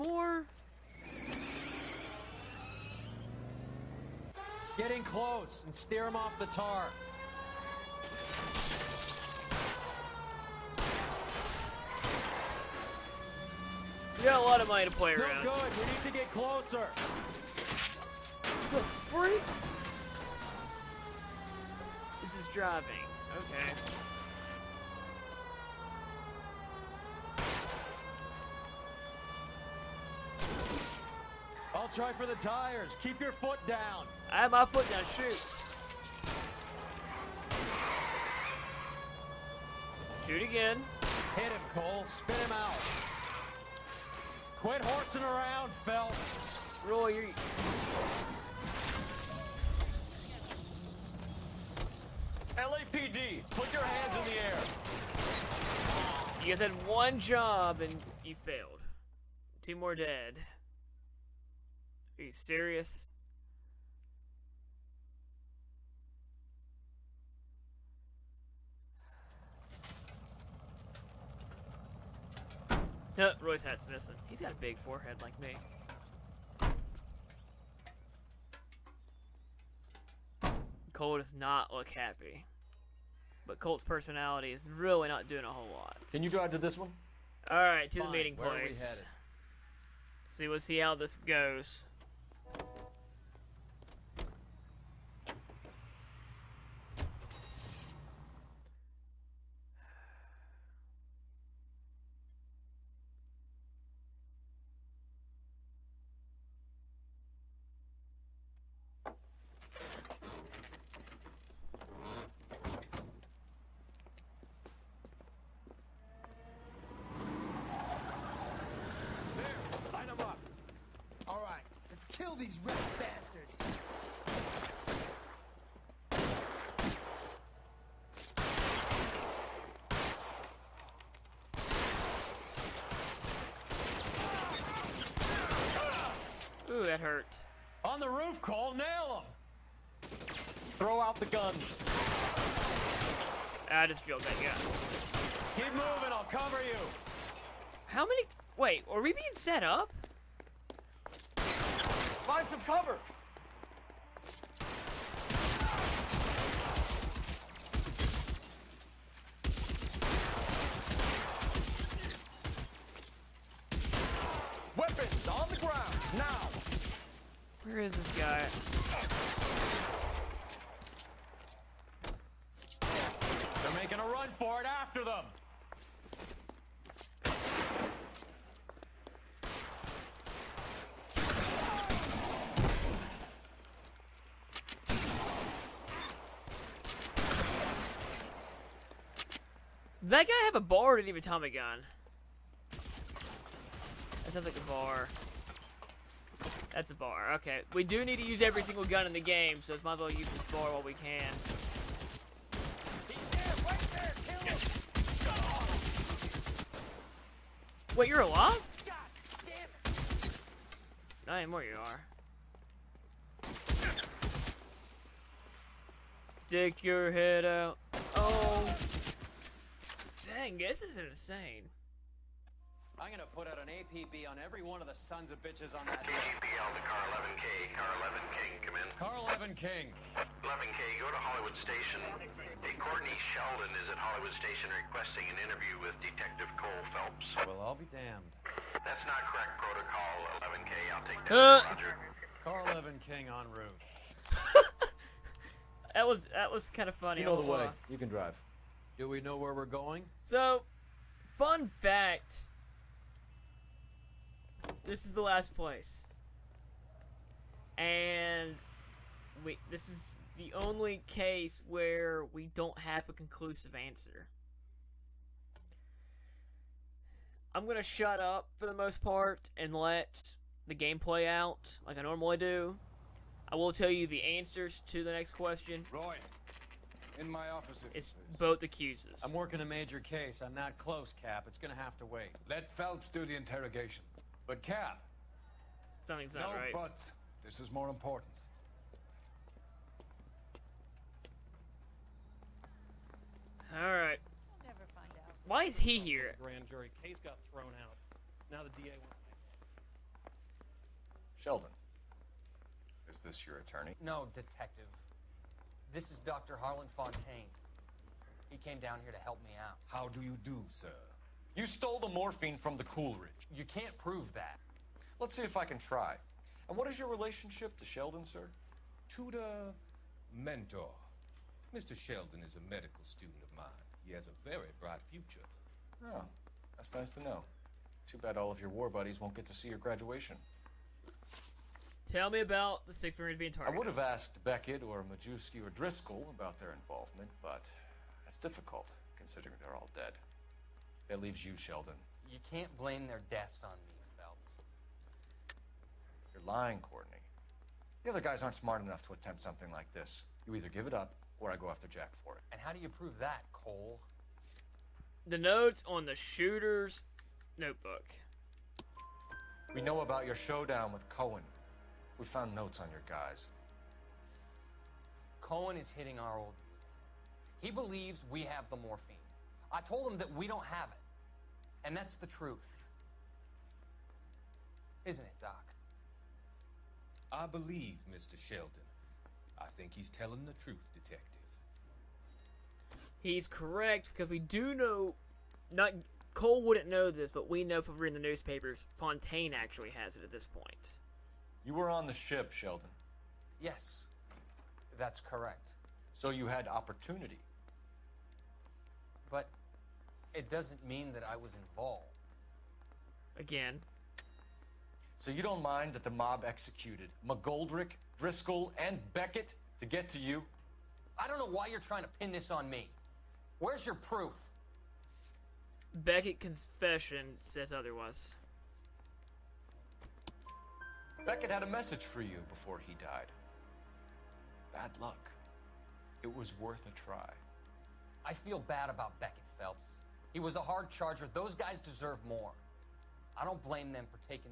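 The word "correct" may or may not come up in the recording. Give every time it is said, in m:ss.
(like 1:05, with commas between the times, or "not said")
3:59, 6:23, 6:35.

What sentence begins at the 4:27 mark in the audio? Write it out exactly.
I'm gonna shut up for the most part and let the game play out like I normally do.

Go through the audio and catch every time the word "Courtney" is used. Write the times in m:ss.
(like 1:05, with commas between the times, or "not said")
3:52, 5:46.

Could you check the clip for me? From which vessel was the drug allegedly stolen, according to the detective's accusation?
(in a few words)
the Coolidge.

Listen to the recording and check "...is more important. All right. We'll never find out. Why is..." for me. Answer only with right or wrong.
right.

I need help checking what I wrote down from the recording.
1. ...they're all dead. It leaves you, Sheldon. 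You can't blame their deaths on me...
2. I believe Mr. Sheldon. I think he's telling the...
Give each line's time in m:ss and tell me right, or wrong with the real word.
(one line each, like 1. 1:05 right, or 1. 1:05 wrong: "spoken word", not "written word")
1. 5:39 right
2. 6:17 right.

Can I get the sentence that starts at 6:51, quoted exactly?
I don't know why you're trying to pin this on me.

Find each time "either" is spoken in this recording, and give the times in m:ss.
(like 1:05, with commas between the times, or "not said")
5:50.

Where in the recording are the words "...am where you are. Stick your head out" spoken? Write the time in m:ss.
3:31.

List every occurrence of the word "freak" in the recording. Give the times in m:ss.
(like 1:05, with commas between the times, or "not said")
0:18.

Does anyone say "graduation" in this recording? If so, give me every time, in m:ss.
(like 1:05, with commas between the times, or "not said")
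5:29.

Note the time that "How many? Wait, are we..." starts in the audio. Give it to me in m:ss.
2:27.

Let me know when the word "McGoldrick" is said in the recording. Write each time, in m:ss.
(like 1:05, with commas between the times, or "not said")
6:47.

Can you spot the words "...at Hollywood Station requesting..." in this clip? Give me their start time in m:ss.
3:53.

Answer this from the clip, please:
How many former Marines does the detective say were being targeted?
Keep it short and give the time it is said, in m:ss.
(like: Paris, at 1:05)
6, at 5:32.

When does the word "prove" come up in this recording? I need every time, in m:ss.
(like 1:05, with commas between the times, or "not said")
5:13, 5:52.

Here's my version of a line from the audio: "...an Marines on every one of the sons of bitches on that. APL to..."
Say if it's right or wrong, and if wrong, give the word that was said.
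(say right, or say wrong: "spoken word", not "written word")
wrong: "APB", not "Marines".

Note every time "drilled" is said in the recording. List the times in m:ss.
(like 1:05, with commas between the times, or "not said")
2:24.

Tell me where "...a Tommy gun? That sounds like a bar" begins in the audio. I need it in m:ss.
3:11.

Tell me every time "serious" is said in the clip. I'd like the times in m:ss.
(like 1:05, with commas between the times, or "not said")
1:02.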